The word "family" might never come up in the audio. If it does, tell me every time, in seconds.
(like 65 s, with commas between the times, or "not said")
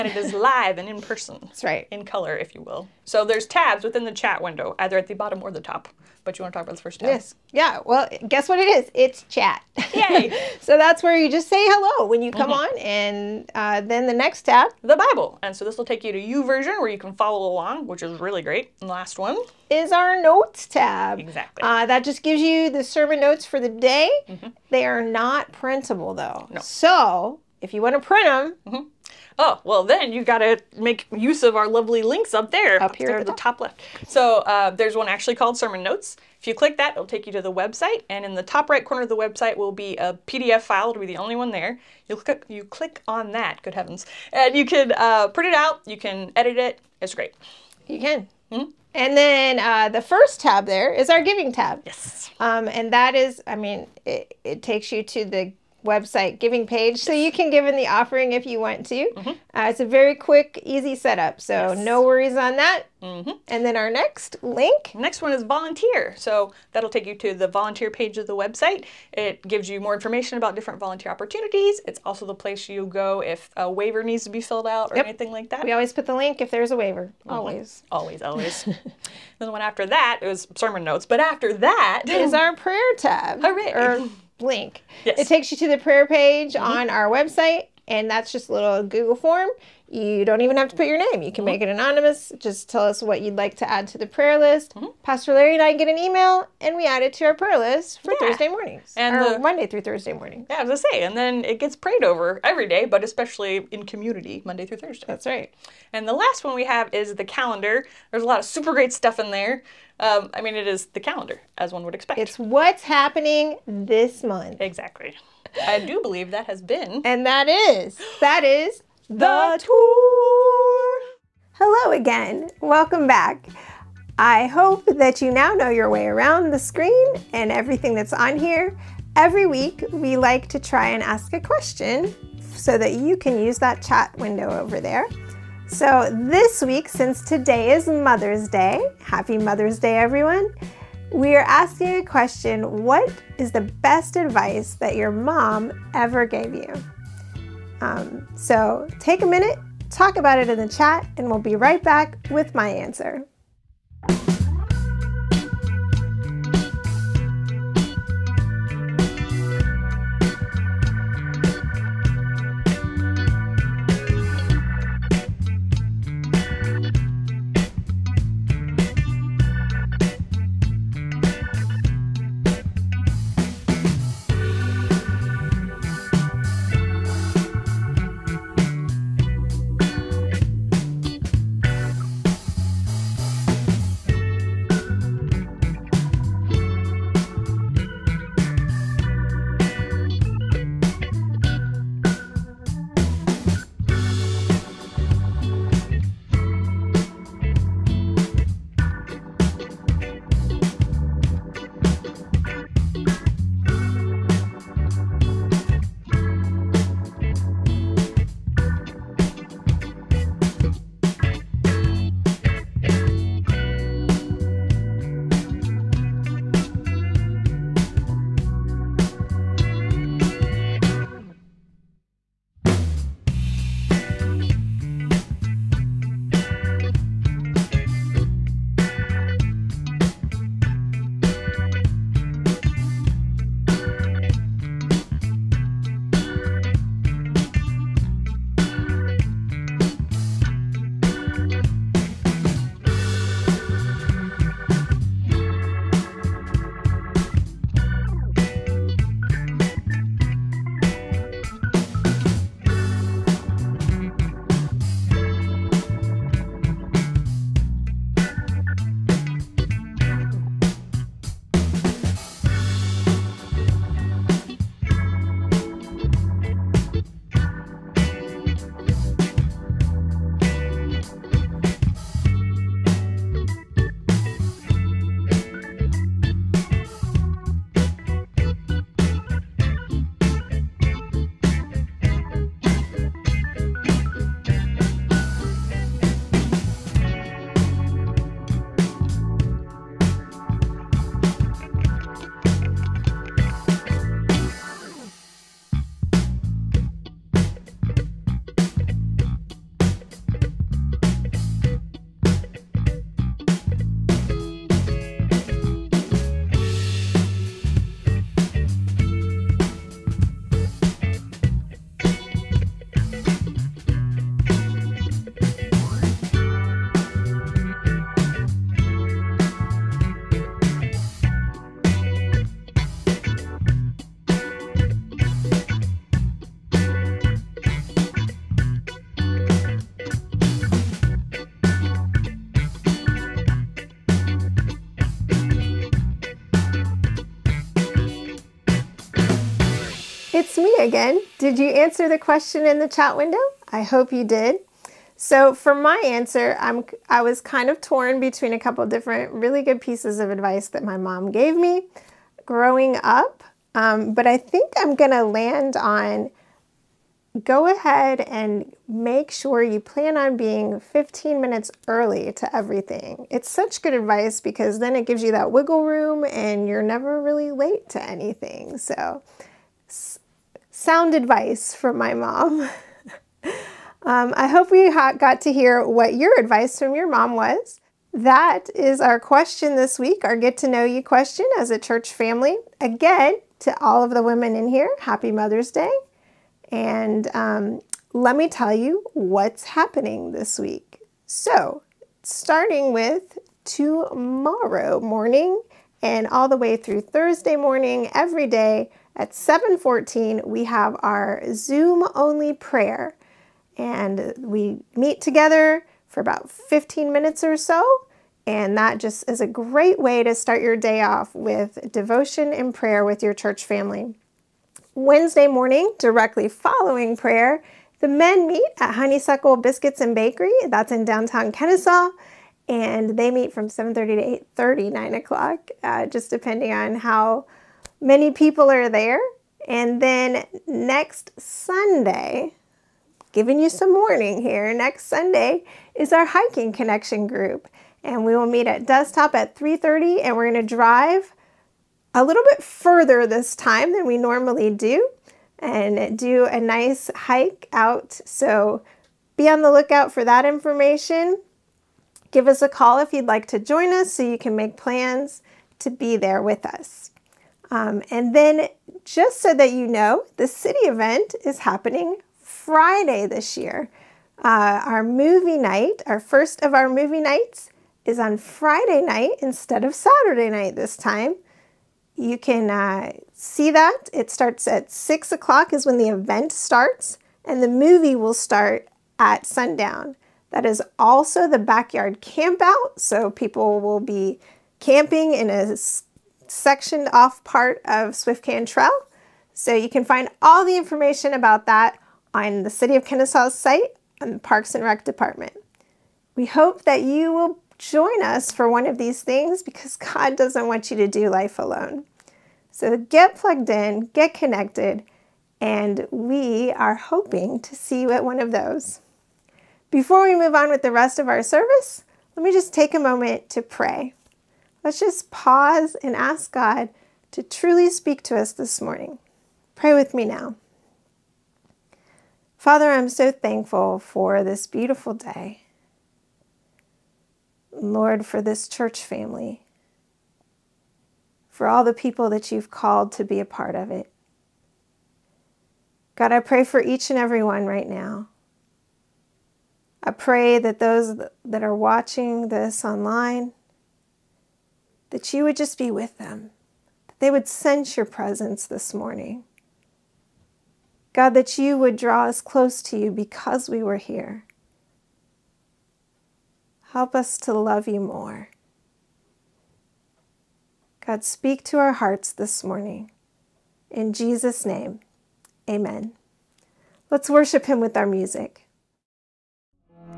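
382 s, 413 s, 529 s.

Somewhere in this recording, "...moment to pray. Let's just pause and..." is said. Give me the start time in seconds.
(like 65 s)
512 s.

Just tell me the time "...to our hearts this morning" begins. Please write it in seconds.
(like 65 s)
561 s.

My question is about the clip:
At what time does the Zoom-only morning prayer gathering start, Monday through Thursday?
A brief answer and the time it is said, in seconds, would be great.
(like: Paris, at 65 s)
7:14, at 399 s.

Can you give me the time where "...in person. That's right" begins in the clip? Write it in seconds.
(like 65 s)
0 s.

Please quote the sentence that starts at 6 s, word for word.
But you want to talk about the first tab?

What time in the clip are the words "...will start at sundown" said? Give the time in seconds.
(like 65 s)
478 s.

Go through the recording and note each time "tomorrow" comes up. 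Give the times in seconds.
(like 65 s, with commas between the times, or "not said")
393 s.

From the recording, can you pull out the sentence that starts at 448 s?
So be on the lookout for that information.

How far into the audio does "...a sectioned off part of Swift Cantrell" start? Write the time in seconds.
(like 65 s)
485 s.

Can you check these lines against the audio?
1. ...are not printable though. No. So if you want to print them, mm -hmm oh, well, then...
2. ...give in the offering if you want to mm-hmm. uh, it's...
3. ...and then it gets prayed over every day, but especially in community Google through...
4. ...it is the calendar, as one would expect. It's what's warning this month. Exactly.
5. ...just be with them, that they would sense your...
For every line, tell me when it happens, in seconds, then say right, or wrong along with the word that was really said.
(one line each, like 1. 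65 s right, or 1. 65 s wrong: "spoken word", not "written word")
1. 24 s right
2. 57 s right
3. 101 s wrong: "Monday", not "Google"
4. 110 s wrong: "happening", not "warning"
5. 545 s right.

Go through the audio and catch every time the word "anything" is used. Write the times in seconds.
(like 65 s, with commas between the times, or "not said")
75 s, 368 s.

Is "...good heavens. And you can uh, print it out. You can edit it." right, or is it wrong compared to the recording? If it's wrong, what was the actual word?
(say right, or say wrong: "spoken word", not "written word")
right.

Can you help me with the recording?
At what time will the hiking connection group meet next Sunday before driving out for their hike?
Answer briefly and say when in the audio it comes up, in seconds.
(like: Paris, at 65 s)
3:30, at 439 s.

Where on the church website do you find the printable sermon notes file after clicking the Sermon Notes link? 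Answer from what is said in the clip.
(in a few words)
top right corner.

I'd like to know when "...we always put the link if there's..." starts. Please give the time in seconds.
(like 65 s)
75 s.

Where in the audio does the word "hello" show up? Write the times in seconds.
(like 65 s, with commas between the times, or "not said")
11 s, 121 s.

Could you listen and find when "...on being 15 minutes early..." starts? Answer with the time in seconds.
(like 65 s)
360 s.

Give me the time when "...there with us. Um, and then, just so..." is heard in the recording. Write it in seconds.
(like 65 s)
456 s.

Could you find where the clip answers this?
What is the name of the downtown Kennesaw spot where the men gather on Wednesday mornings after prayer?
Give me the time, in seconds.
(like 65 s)
418 s.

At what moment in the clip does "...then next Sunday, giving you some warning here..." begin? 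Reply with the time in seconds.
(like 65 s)
430 s.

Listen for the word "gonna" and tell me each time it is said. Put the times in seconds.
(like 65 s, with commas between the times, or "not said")
354 s, 440 s.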